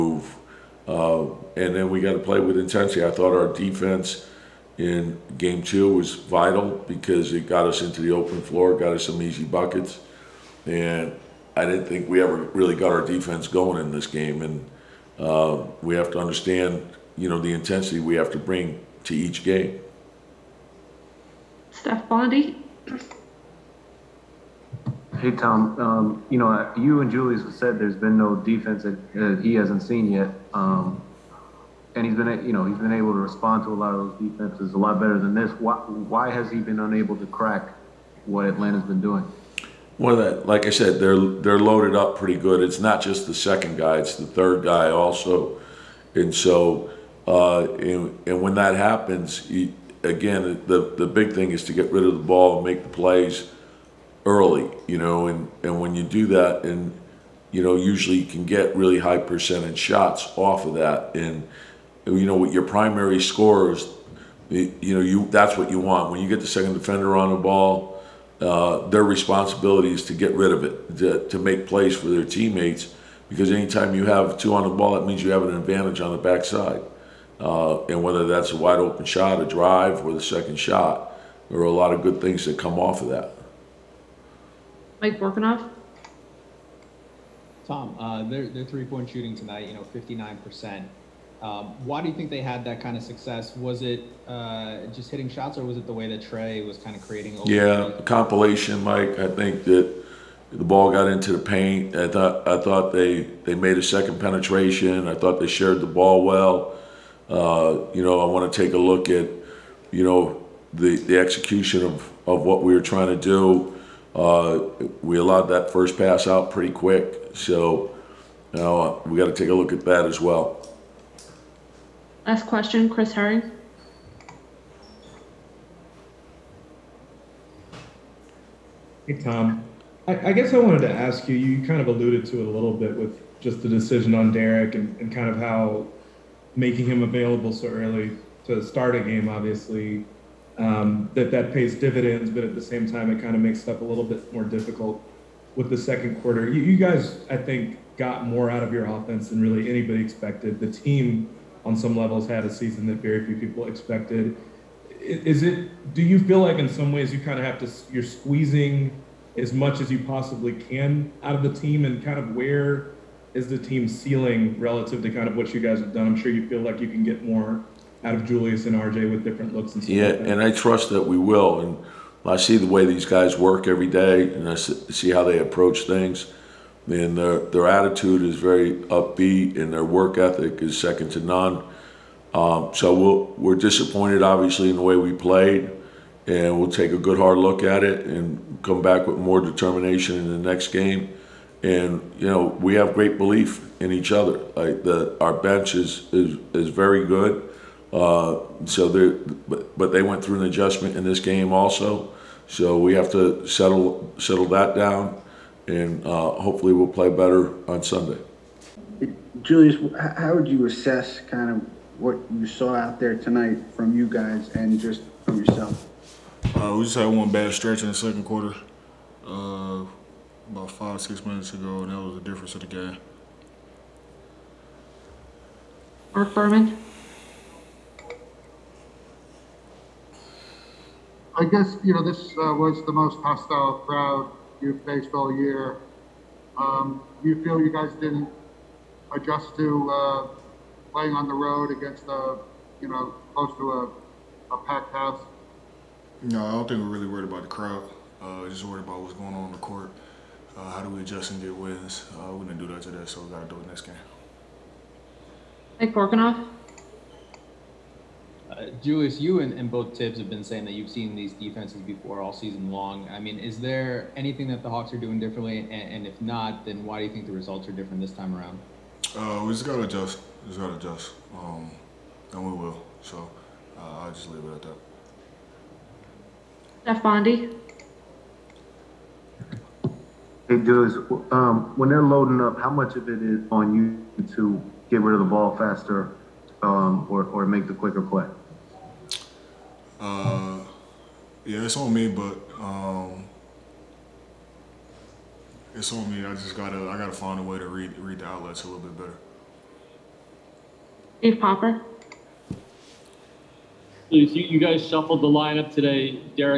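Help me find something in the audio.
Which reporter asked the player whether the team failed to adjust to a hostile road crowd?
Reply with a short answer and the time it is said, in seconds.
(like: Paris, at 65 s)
Marc Berman, at 226 s.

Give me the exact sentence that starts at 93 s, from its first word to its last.
Was it uh, just hitting shots, or was it the way that Trae was kind of creating?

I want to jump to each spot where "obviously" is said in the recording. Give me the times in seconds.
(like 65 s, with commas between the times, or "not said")
139 s, 184 s.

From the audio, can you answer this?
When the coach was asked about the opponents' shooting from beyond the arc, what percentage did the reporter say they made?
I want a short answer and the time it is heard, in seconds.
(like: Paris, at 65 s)
59%, at 89 s.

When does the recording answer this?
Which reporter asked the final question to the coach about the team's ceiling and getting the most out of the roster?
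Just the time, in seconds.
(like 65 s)
122 s.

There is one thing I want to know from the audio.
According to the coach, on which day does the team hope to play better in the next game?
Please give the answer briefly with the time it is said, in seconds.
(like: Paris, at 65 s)
Sunday, at 207 s.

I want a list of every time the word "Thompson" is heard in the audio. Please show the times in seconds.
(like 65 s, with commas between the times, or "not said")
not said.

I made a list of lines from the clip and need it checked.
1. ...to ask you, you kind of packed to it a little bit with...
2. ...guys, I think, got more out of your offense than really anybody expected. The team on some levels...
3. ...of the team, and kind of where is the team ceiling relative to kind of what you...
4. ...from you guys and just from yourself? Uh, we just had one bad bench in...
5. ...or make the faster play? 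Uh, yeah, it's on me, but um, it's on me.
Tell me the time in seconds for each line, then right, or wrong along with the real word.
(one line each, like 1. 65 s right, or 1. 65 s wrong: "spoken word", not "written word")
1. 130 s wrong: "alluded", not "packed"
2. 146 s right
3. 161 s right
4. 213 s wrong: "stretch", not "bench"
5. 287 s wrong: "quicker", not "faster".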